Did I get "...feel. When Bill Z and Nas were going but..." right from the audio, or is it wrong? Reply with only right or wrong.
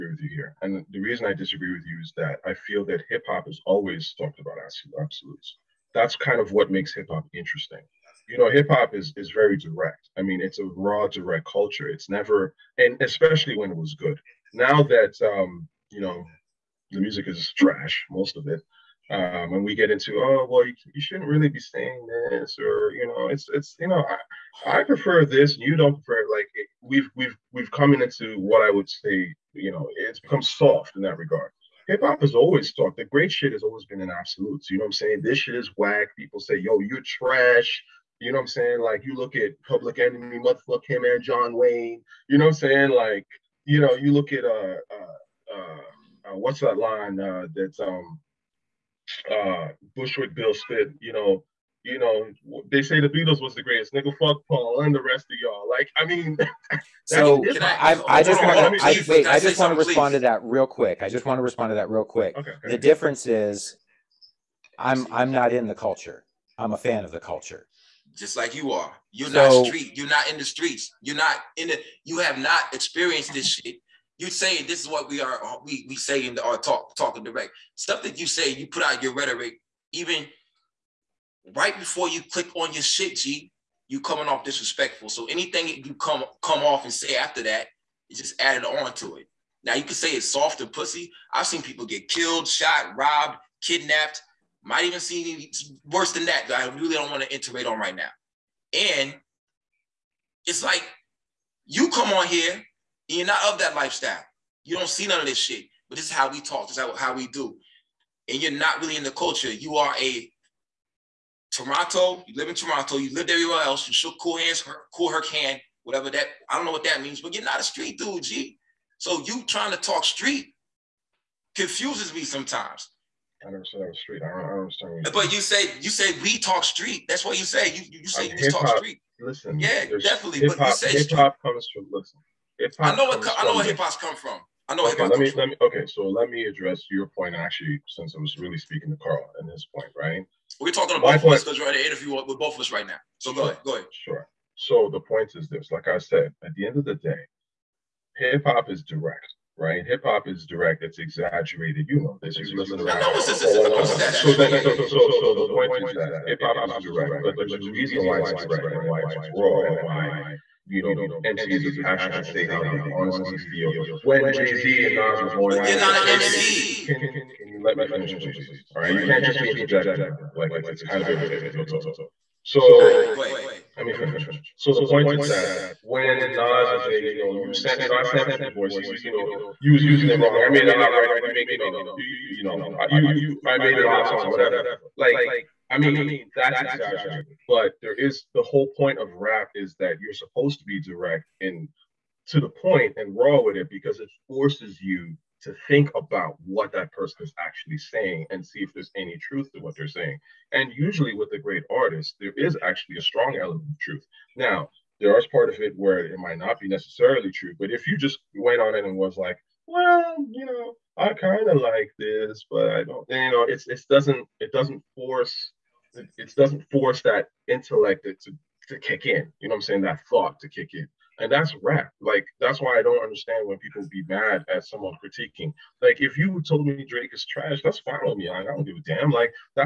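wrong.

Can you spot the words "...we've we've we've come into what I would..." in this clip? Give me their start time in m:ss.
0:26.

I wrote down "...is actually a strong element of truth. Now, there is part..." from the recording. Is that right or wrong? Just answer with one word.
right.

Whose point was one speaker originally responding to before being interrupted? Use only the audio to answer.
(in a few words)
Carl.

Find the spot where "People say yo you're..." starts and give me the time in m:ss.
0:36.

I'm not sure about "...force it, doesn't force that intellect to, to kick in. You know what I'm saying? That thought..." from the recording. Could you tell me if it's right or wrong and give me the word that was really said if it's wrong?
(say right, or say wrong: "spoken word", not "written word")
right.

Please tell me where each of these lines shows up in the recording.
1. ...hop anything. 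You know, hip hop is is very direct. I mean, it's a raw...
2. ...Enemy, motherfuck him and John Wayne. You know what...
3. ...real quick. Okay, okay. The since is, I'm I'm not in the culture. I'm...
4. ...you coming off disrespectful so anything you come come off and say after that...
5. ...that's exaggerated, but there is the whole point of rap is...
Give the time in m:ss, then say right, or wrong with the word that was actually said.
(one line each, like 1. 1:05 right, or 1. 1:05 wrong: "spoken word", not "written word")
1. 0:07 wrong: "interesting", not "anything"
2. 0:39 right
3. 1:01 wrong: "difference", not "since"
4. 1:23 right
5. 3:06 right.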